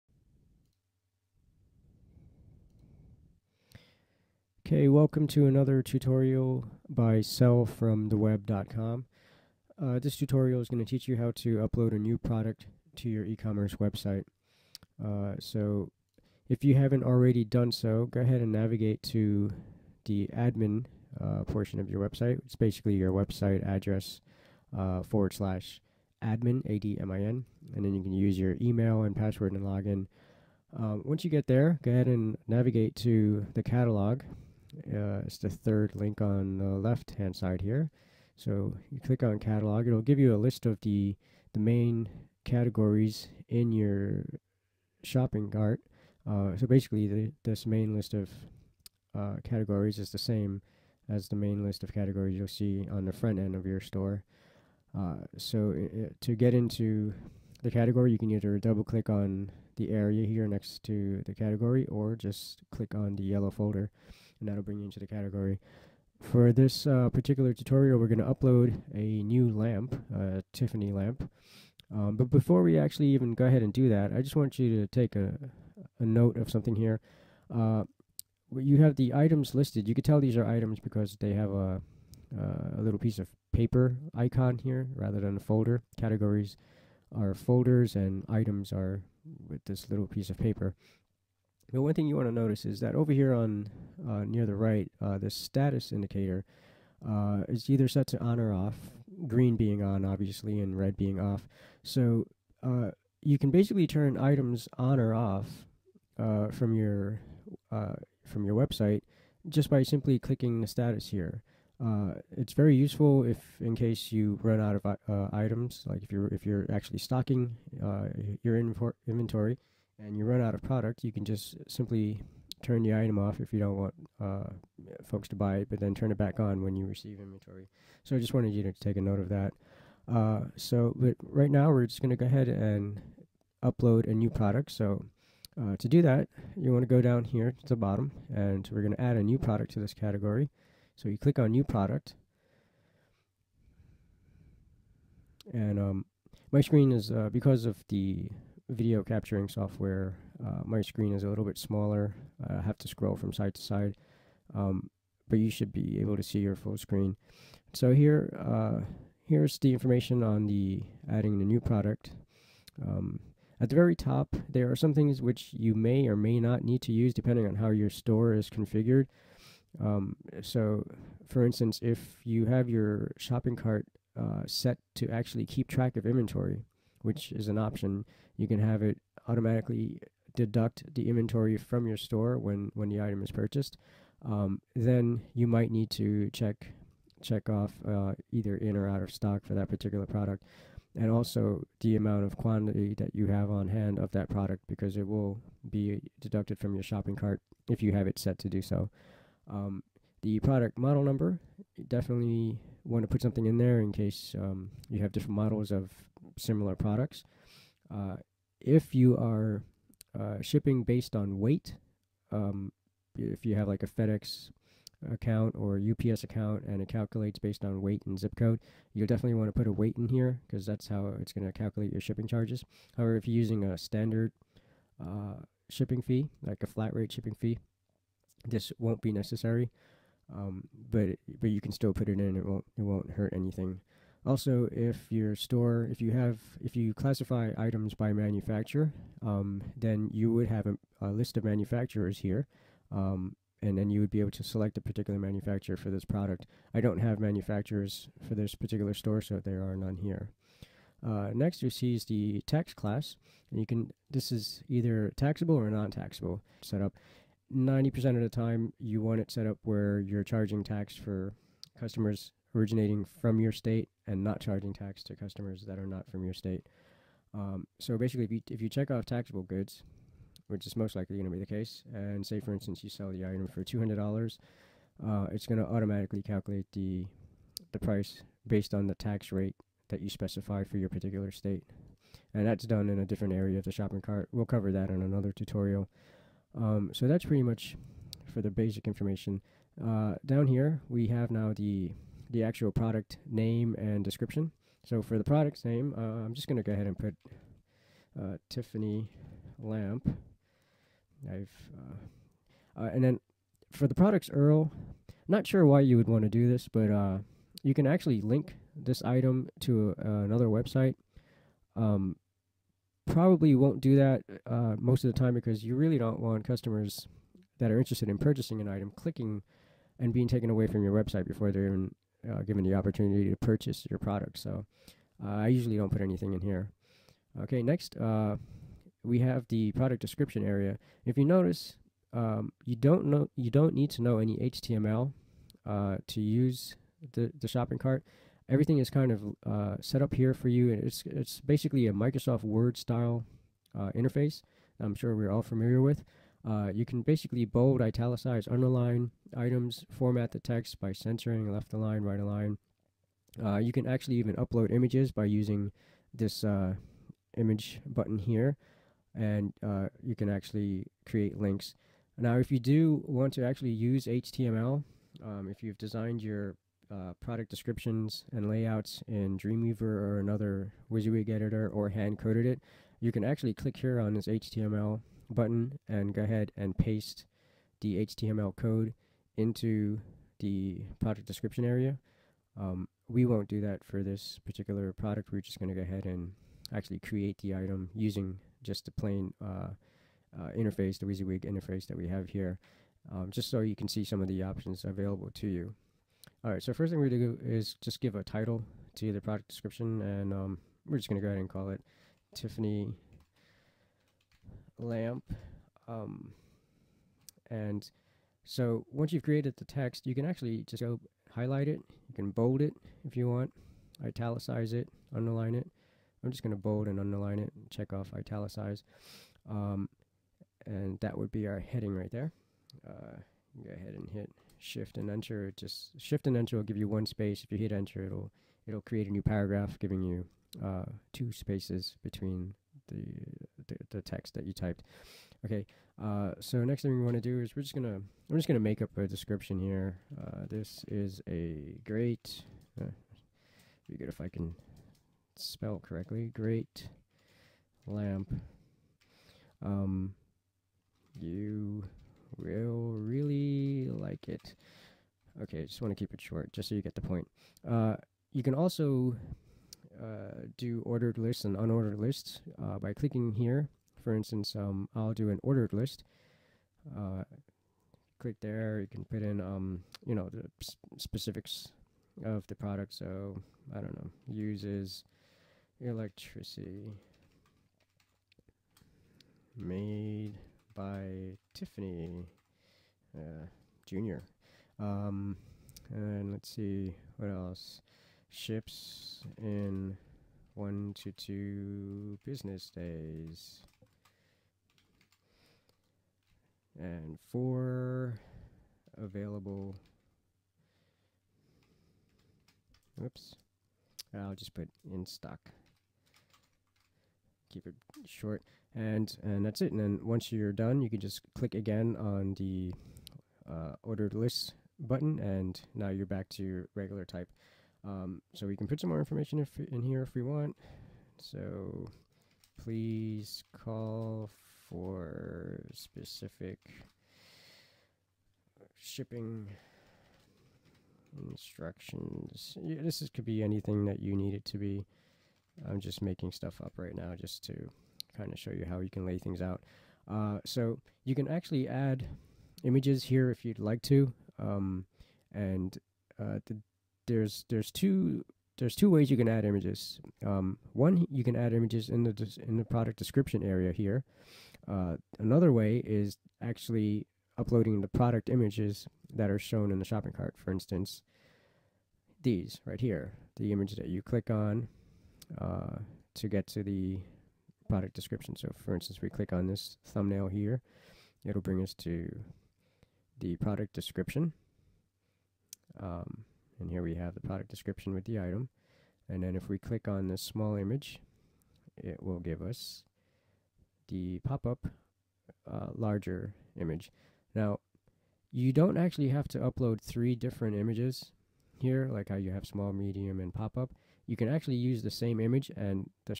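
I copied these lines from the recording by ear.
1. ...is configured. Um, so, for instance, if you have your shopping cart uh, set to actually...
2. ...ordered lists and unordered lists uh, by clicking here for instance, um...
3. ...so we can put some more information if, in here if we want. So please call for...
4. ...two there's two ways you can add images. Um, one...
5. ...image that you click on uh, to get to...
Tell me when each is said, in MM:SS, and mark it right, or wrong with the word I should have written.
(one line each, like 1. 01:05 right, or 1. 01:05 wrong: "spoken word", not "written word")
1. 02:48 right
2. 07:40 right
3. 08:38 right
4. 09:07 right
5. 09:23 right.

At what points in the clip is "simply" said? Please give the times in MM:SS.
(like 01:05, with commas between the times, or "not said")
01:49, 02:01.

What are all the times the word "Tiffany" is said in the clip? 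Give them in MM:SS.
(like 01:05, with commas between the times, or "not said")
01:10, 04:58, 06:42, 08:01.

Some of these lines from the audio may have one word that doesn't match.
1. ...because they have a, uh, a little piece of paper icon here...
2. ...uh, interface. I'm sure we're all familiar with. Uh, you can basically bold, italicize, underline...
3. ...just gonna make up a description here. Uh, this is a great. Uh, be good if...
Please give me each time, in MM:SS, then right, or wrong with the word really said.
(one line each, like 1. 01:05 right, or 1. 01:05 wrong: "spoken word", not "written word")
1. 01:20 right
2. 05:43 right
3. 07:18 right.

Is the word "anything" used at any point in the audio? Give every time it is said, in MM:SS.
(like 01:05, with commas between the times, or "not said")
03:53, 05:26, 08:53.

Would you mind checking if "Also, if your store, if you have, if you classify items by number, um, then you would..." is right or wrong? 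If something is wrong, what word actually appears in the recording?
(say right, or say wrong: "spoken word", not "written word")
wrong: "manufacturer", not "number".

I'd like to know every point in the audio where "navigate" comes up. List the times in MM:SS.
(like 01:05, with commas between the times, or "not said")
00:18, 00:32.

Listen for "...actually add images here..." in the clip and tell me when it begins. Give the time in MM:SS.
09:01.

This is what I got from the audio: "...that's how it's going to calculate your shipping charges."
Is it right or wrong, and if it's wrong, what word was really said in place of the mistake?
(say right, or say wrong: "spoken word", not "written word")
right.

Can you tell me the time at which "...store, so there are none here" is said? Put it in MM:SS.
04:08.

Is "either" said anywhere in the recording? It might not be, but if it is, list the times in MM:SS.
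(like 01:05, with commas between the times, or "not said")
00:58, 01:37, 03:08, 04:14.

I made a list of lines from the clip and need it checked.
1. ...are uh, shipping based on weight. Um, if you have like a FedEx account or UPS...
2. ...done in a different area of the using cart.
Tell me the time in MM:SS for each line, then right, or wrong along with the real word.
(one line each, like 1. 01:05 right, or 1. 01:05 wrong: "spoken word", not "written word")
1. 03:29 right
2. 04:42 wrong: "shopping", not "using".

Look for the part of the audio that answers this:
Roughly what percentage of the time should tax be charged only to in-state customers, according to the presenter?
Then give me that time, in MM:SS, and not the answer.
04:17.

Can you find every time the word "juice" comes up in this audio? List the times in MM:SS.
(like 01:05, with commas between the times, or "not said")
not said.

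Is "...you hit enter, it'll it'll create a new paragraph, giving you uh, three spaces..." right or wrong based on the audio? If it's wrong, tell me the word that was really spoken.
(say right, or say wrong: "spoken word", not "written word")
wrong: "two", not "three".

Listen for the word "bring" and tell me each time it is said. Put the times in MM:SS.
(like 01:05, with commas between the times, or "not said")
01:04, 09:31.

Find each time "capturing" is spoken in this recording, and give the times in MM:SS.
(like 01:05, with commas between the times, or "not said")
02:29.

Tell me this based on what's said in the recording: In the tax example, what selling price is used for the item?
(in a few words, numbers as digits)
$200.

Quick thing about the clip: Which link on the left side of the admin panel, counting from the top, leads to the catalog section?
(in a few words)
third.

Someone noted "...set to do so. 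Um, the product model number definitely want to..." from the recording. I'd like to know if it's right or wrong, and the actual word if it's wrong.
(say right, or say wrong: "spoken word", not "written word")
right.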